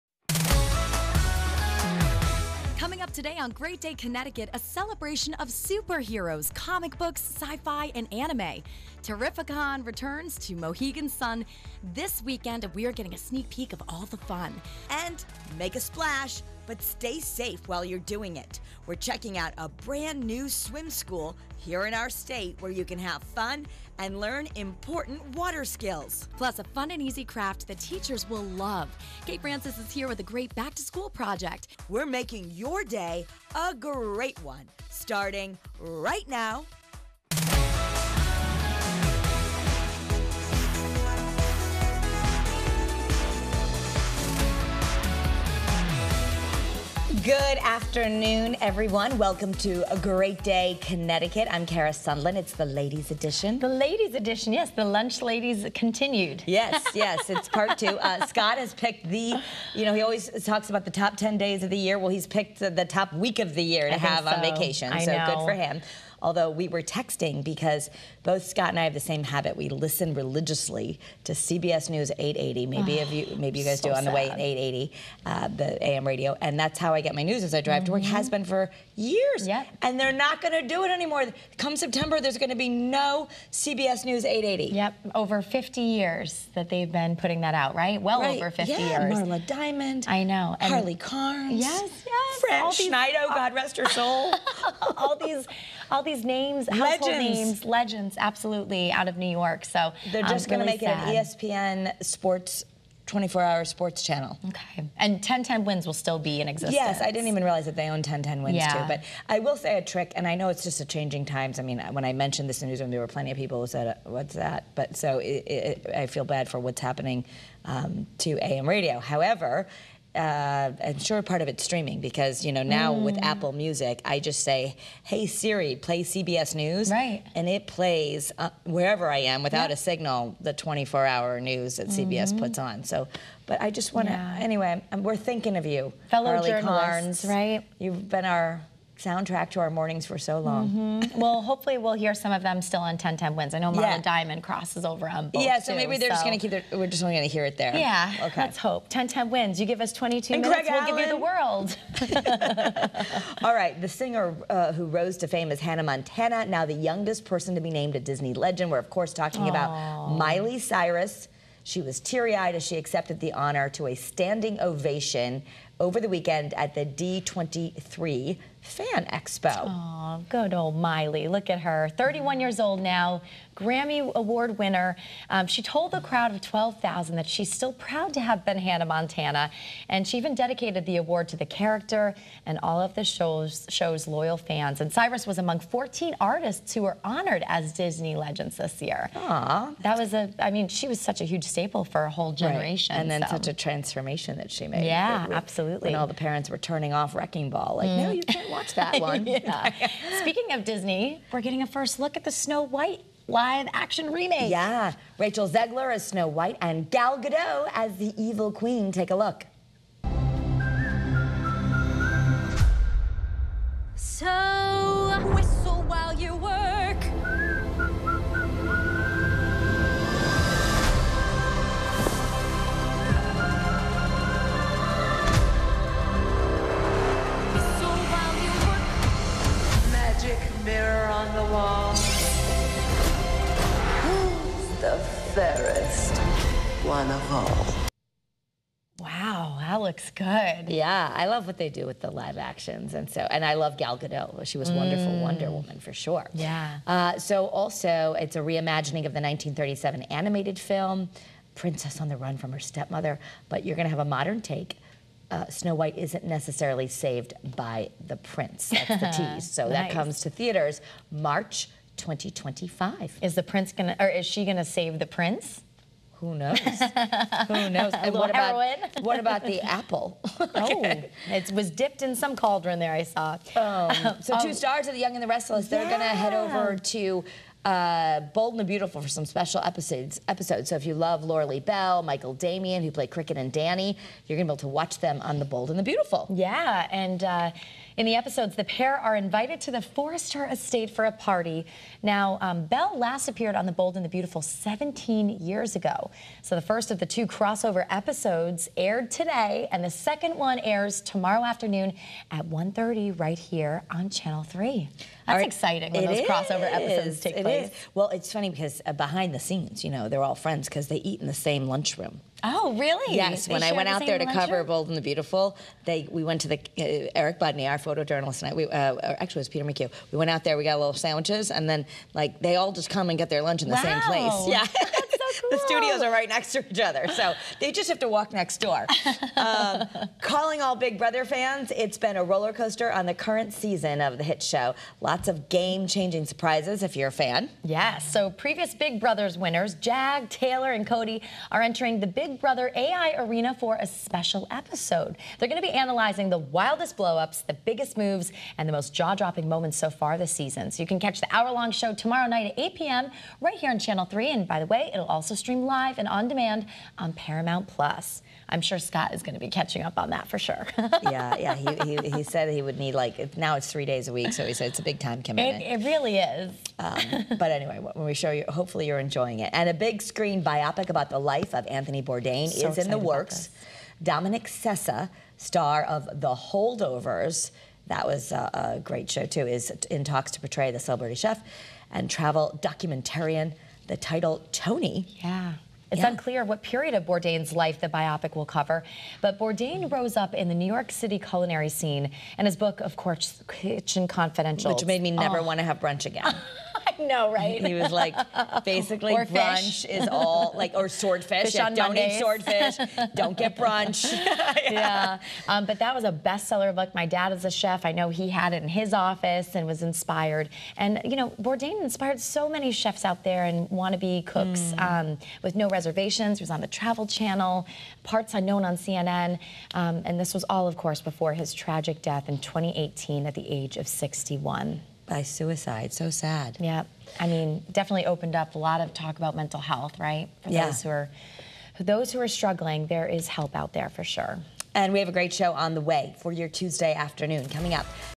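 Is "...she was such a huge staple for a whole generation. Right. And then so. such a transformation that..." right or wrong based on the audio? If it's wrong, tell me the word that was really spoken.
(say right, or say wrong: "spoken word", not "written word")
right.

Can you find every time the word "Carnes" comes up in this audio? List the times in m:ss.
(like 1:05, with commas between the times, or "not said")
1:30, 2:16.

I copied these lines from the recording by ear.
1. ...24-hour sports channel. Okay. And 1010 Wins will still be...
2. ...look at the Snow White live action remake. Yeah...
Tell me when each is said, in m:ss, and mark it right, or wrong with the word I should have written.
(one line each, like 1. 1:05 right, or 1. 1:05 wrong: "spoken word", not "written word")
1. 1:43 right
2. 3:21 right.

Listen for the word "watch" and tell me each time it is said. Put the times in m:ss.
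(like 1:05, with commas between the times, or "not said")
3:18, 4:44.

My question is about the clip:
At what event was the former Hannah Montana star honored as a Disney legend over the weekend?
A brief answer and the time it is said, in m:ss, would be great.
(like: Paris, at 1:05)
D23 Fan Expo, at 2:46.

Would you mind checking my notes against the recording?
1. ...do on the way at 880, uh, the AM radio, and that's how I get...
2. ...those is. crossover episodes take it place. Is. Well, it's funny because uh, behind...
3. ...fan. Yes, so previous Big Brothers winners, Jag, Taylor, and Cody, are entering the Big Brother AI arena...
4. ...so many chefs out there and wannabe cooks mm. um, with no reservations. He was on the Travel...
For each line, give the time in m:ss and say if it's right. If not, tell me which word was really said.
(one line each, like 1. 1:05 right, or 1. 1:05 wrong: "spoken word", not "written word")
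1. 1:13 right
2. 5:06 right
3. 5:37 right
4. 6:52 right.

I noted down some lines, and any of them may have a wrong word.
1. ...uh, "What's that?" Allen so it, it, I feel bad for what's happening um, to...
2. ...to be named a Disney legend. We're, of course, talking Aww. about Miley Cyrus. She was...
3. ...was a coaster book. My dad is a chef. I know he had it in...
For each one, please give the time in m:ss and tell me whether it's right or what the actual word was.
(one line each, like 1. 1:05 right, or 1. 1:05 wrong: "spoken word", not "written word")
1. 1:53 wrong: "But", not "Allen"
2. 2:37 right
3. 6:45 wrong: "bestseller", not "coaster".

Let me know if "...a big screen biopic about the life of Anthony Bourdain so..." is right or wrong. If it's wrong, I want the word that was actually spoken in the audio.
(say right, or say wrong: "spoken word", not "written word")
right.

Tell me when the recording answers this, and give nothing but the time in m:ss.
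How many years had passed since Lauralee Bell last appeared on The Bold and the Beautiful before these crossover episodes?
4:54.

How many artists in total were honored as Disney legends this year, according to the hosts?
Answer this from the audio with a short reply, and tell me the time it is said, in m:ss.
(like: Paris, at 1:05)
14, at 3:05.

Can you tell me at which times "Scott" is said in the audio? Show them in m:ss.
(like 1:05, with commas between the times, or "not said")
0:58, 1:08, 5:58.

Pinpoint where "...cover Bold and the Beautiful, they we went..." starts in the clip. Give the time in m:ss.
5:14.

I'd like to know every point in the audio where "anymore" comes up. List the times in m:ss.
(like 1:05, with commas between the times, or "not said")
1:20.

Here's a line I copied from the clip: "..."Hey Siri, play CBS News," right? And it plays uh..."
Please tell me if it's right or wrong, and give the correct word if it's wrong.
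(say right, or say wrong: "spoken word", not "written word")
right.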